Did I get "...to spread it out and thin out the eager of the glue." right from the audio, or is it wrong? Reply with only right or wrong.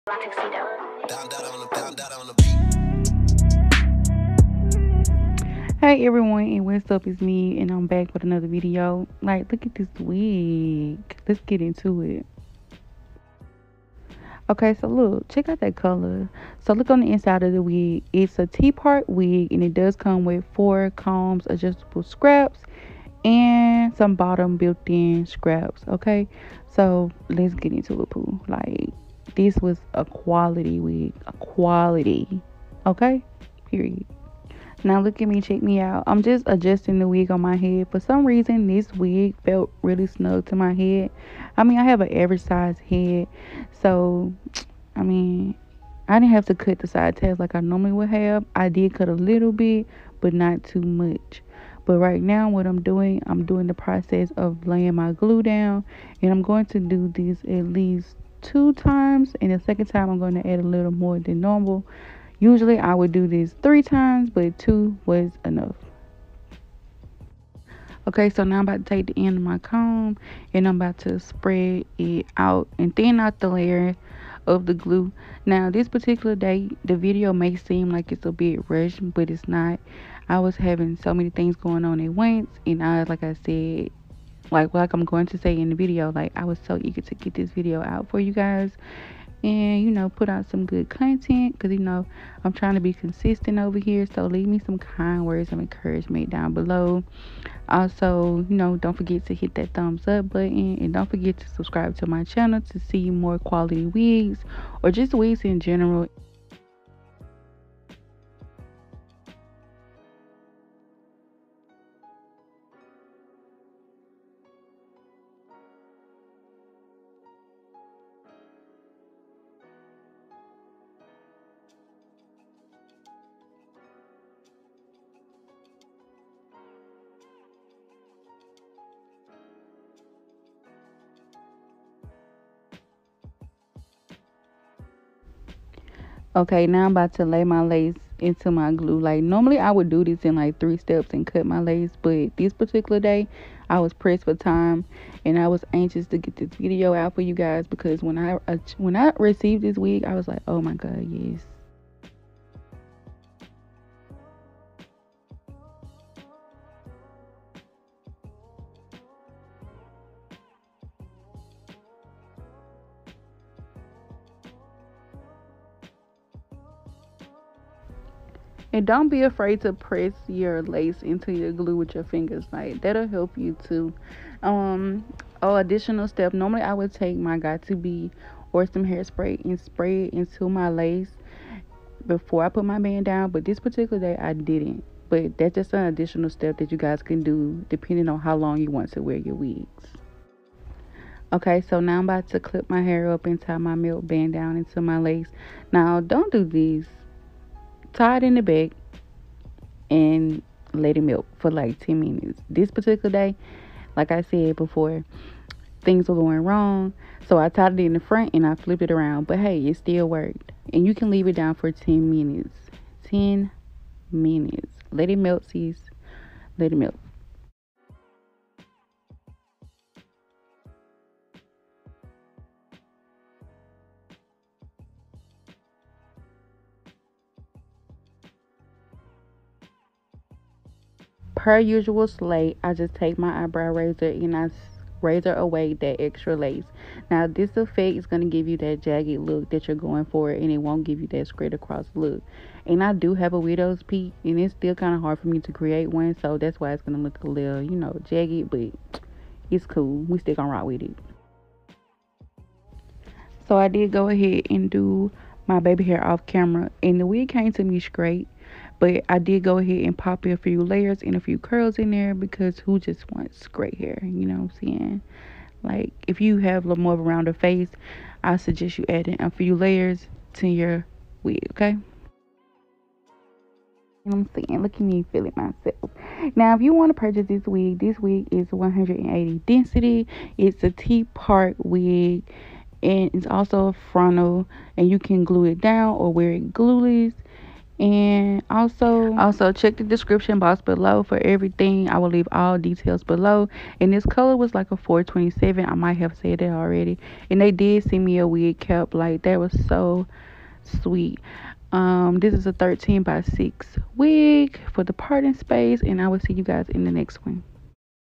wrong.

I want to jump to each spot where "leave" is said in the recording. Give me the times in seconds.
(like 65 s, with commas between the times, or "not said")
94 s, 211 s, 292 s.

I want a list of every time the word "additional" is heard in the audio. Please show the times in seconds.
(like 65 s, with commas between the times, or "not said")
175 s, 185 s.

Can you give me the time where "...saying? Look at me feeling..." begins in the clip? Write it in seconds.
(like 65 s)
274 s.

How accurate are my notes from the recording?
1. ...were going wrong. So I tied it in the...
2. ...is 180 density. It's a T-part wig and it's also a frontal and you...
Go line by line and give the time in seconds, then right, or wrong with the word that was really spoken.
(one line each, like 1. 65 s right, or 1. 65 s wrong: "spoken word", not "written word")
1. 206 s right
2. 278 s right.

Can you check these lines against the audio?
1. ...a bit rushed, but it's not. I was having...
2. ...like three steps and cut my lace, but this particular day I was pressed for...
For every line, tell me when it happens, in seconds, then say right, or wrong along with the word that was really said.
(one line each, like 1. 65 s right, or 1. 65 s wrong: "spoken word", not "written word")
1. 78 s right
2. 140 s right.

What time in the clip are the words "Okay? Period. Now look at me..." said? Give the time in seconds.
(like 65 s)
32 s.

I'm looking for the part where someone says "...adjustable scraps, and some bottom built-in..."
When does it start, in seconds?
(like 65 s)
21 s.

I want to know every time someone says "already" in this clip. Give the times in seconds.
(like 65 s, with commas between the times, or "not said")
296 s.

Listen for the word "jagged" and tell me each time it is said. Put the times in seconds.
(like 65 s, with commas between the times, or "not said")
238 s, 248 s.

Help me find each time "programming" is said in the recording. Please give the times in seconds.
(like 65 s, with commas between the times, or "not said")
not said.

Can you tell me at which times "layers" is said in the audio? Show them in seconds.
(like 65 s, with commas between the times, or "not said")
73 s, 260 s, 269 s.